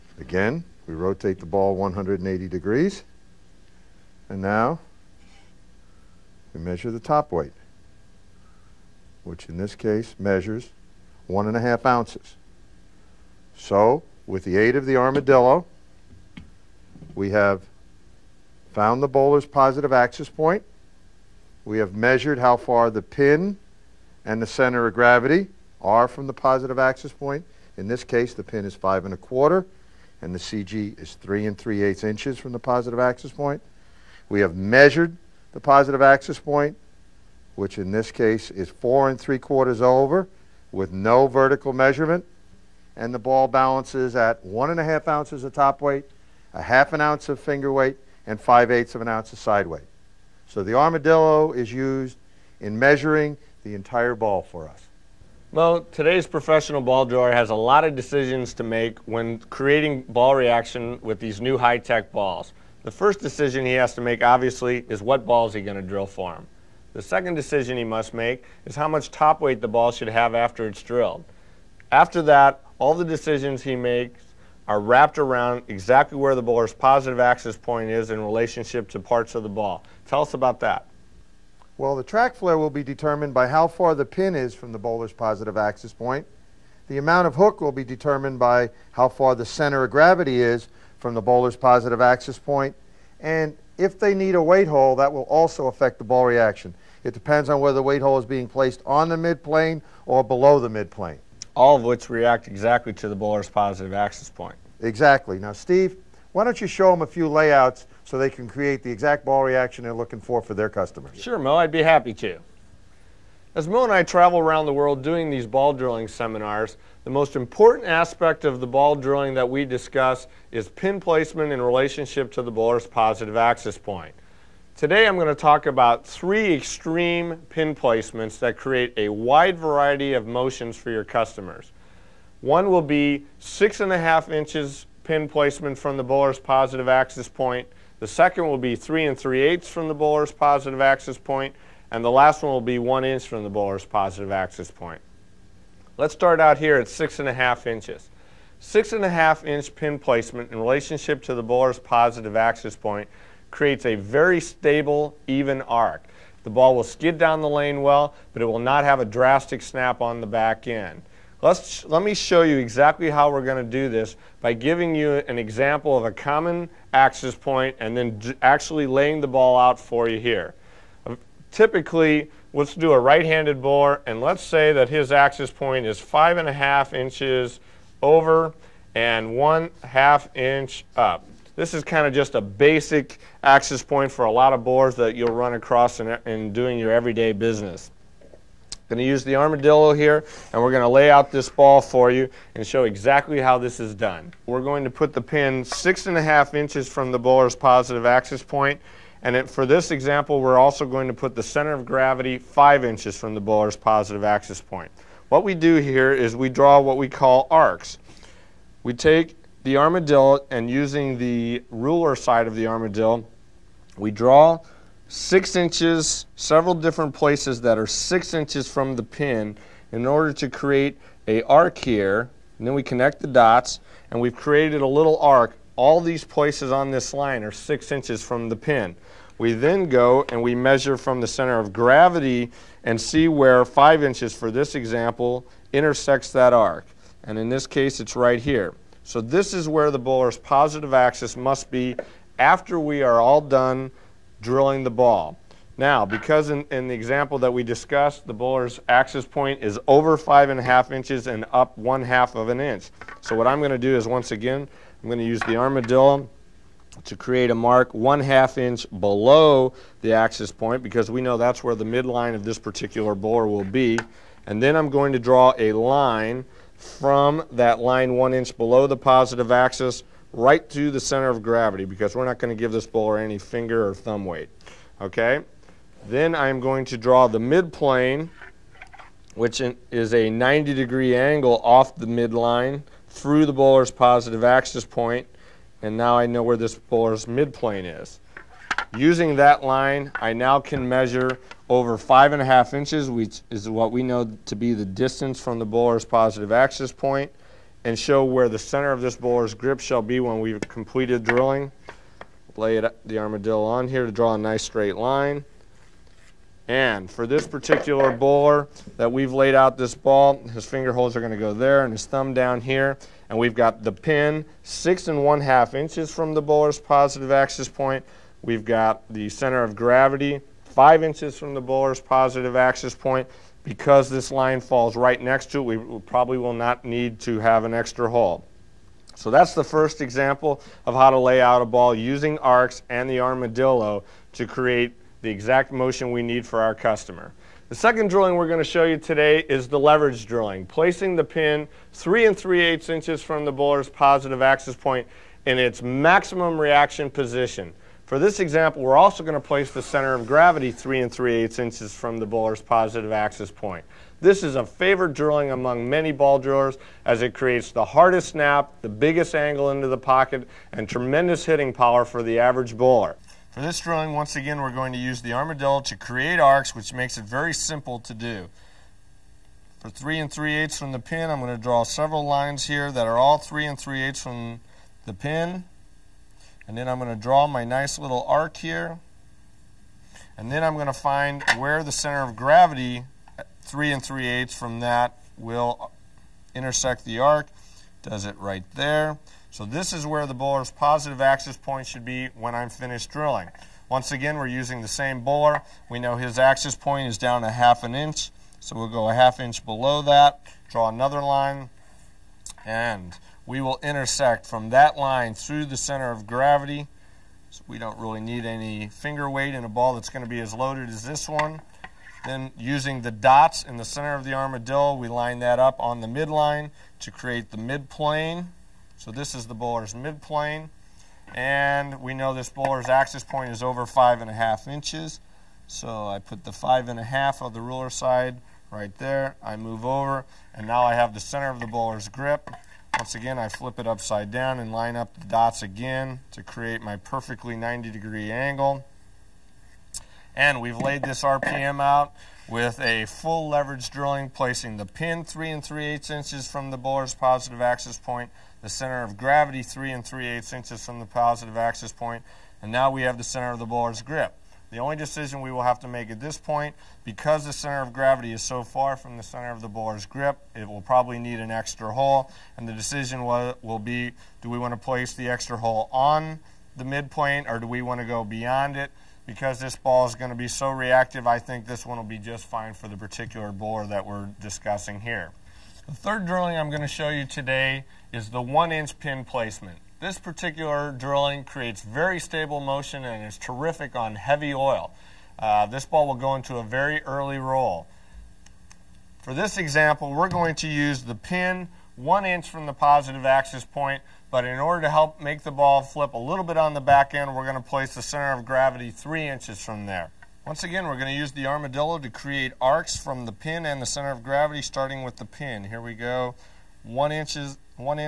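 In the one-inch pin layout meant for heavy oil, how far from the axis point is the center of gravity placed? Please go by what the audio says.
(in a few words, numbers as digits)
3 inches.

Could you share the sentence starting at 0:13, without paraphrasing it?
So with the aid of the armadillo, we have found the bowler's positive axis point.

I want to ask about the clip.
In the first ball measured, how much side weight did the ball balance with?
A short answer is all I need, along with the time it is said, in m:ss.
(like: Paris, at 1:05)
5/8 ounce, at 0:48.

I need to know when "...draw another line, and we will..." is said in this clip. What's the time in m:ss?
6:40.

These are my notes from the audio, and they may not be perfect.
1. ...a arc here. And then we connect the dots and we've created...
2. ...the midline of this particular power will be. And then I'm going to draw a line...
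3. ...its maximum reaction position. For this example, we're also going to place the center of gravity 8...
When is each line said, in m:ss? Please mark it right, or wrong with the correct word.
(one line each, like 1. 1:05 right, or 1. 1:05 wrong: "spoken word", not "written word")
1. 3:41 right
2. 4:21 wrong: "bowler", not "power"
3. 5:45 wrong: "3", not "8".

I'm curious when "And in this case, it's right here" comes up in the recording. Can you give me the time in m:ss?
3:57.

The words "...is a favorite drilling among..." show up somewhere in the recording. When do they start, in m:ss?
5:54.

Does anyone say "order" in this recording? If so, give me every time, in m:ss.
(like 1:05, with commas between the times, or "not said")
3:40, 8:14.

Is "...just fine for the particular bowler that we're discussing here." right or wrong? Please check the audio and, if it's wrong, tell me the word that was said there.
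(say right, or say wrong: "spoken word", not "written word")
right.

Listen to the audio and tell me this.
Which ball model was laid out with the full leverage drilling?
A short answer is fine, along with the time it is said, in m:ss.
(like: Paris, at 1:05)
RPM, at 7:21.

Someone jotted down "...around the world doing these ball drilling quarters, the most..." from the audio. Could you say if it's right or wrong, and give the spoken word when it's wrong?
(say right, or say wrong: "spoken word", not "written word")
wrong: "seminars", not "quarters".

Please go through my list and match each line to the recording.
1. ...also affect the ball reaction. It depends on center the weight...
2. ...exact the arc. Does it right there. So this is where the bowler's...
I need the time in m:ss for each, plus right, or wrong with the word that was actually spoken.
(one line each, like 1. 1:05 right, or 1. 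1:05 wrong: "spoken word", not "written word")
1. 1:35 wrong: "whether", not "center"
2. 6:26 wrong: "intersect", not "exact".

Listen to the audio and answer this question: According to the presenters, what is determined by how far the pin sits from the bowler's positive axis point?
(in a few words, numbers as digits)
Track flare.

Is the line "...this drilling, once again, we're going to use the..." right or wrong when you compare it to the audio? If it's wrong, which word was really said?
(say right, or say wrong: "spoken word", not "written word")
right.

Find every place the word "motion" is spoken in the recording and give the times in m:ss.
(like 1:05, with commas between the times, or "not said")
2:10, 5:35, 8:02.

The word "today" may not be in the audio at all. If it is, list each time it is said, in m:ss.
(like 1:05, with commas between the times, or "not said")
0:55, 2:04, 5:38, 7:57.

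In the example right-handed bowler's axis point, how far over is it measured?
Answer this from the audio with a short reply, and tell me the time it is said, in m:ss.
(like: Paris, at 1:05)
5 1/2 inches, at 2:55.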